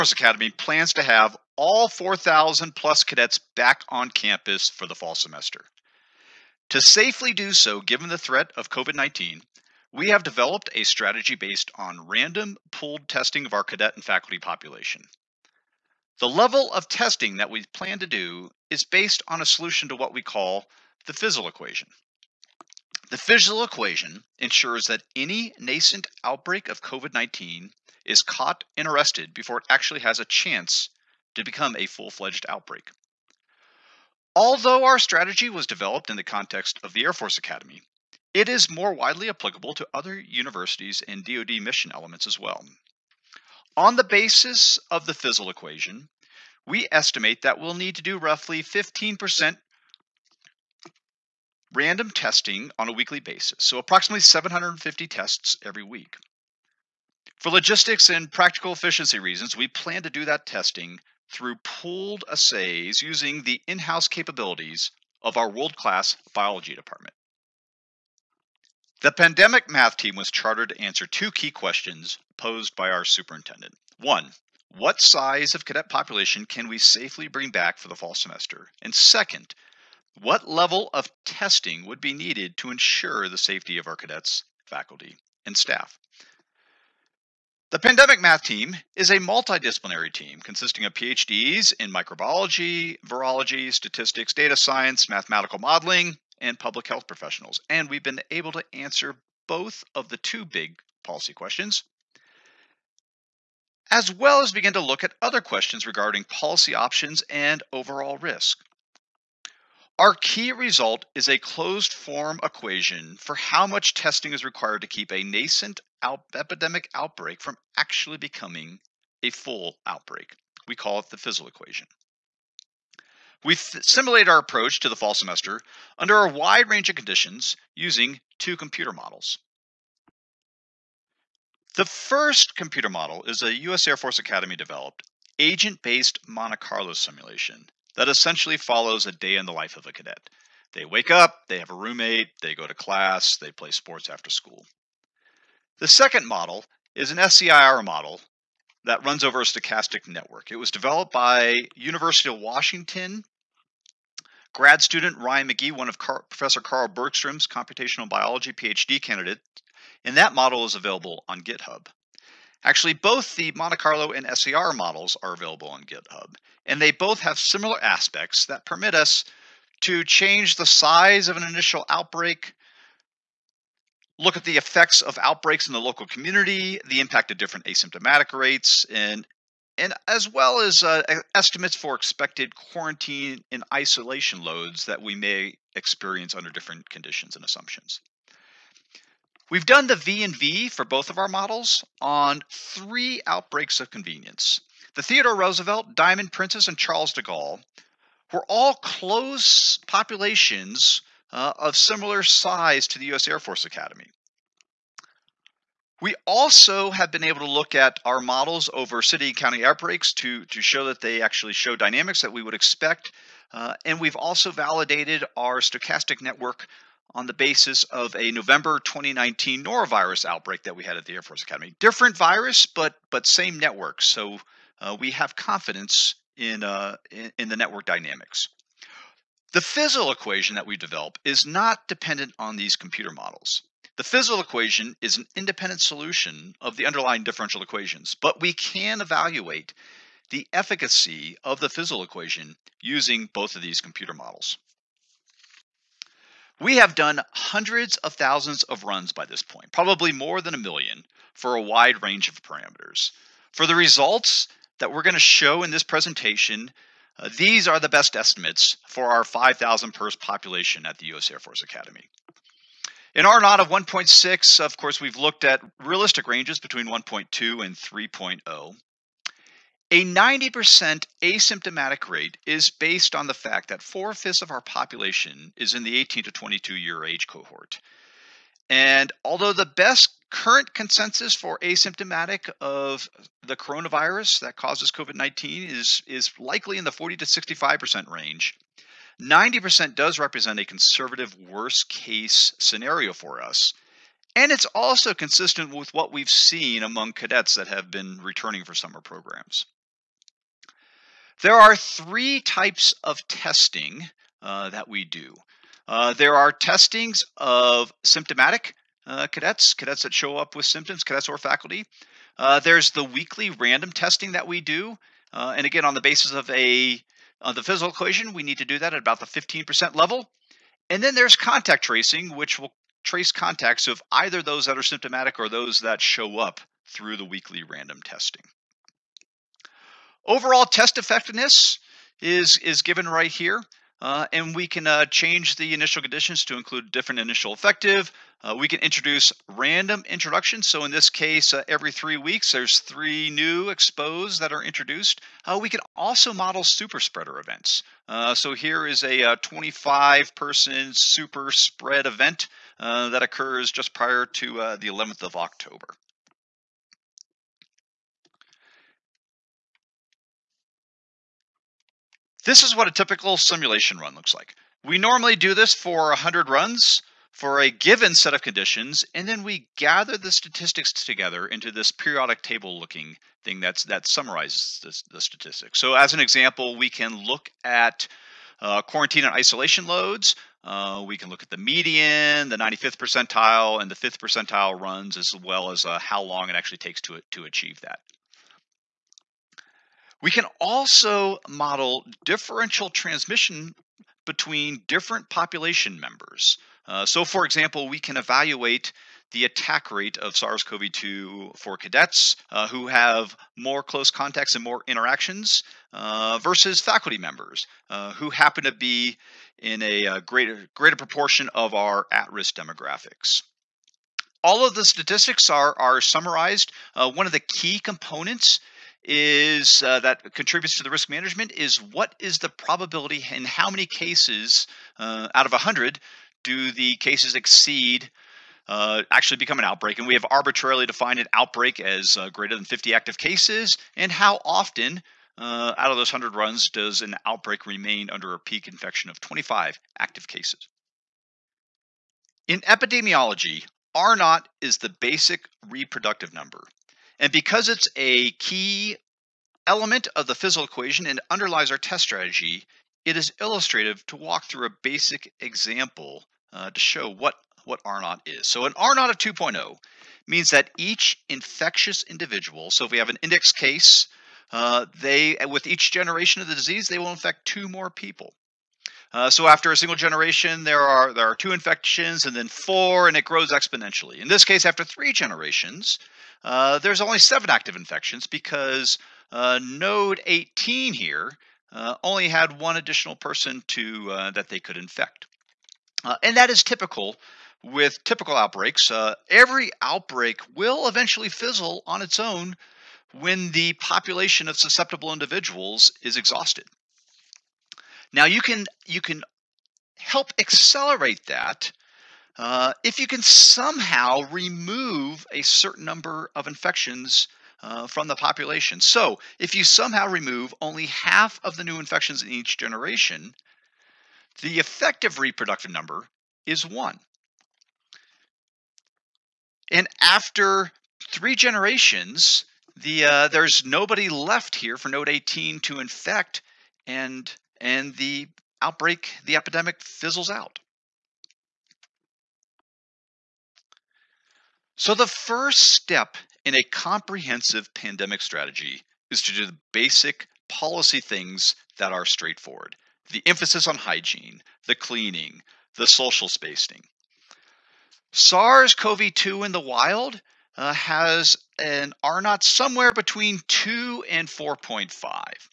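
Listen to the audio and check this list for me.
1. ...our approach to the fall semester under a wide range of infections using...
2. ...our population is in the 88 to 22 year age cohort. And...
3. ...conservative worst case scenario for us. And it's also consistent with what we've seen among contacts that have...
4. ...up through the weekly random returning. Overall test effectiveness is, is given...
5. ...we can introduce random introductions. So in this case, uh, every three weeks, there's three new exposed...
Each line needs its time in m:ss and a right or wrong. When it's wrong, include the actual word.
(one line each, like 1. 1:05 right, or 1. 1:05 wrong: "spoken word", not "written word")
1. 2:04 wrong: "conditions", not "infections"
2. 4:34 wrong: "18", not "88"
3. 4:50 wrong: "cadets", not "contacts"
4. 5:26 wrong: "testing", not "returning"
5. 5:38 right.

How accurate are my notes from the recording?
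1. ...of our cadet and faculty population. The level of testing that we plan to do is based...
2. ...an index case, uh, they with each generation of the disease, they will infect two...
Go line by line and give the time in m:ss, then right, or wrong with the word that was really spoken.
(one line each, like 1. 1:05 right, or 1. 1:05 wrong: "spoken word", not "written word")
1. 0:13 right
2. 7:43 right.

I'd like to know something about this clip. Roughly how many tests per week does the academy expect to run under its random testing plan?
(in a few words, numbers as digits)
750.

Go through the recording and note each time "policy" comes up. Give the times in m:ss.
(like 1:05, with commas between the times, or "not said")
1:41, 1:46, 9:00.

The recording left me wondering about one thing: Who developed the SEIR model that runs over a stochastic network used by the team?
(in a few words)
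Ryan McGee.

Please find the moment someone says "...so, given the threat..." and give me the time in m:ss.
0:07.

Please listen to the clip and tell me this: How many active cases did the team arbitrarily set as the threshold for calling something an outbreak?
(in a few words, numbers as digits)
more than 50.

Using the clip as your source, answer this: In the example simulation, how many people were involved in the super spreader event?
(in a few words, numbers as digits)
25.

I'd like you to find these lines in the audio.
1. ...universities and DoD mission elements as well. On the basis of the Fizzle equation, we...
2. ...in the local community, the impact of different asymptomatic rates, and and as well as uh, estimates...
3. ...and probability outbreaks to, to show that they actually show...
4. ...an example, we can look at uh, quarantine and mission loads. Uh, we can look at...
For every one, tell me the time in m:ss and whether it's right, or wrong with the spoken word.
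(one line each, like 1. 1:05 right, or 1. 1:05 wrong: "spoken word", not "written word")
1. 0:40 right
2. 2:55 right
3. 3:29 wrong: "county", not "probability"
4. 6:16 wrong: "isolation", not "mission".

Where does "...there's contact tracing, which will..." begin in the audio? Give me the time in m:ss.
5:21.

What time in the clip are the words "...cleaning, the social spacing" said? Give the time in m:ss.
9:04.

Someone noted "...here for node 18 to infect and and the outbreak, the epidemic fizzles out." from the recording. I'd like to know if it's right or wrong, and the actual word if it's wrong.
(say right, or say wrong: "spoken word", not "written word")
right.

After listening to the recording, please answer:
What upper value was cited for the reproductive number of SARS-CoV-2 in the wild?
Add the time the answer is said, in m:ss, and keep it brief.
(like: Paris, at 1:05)
4.5, at 9:14.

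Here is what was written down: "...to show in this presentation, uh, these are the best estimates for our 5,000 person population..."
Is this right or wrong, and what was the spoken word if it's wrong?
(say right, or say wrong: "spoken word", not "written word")
right.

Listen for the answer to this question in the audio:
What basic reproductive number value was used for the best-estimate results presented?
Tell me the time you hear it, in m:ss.
4:23.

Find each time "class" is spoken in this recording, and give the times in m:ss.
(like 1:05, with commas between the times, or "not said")
1:05, 2:22.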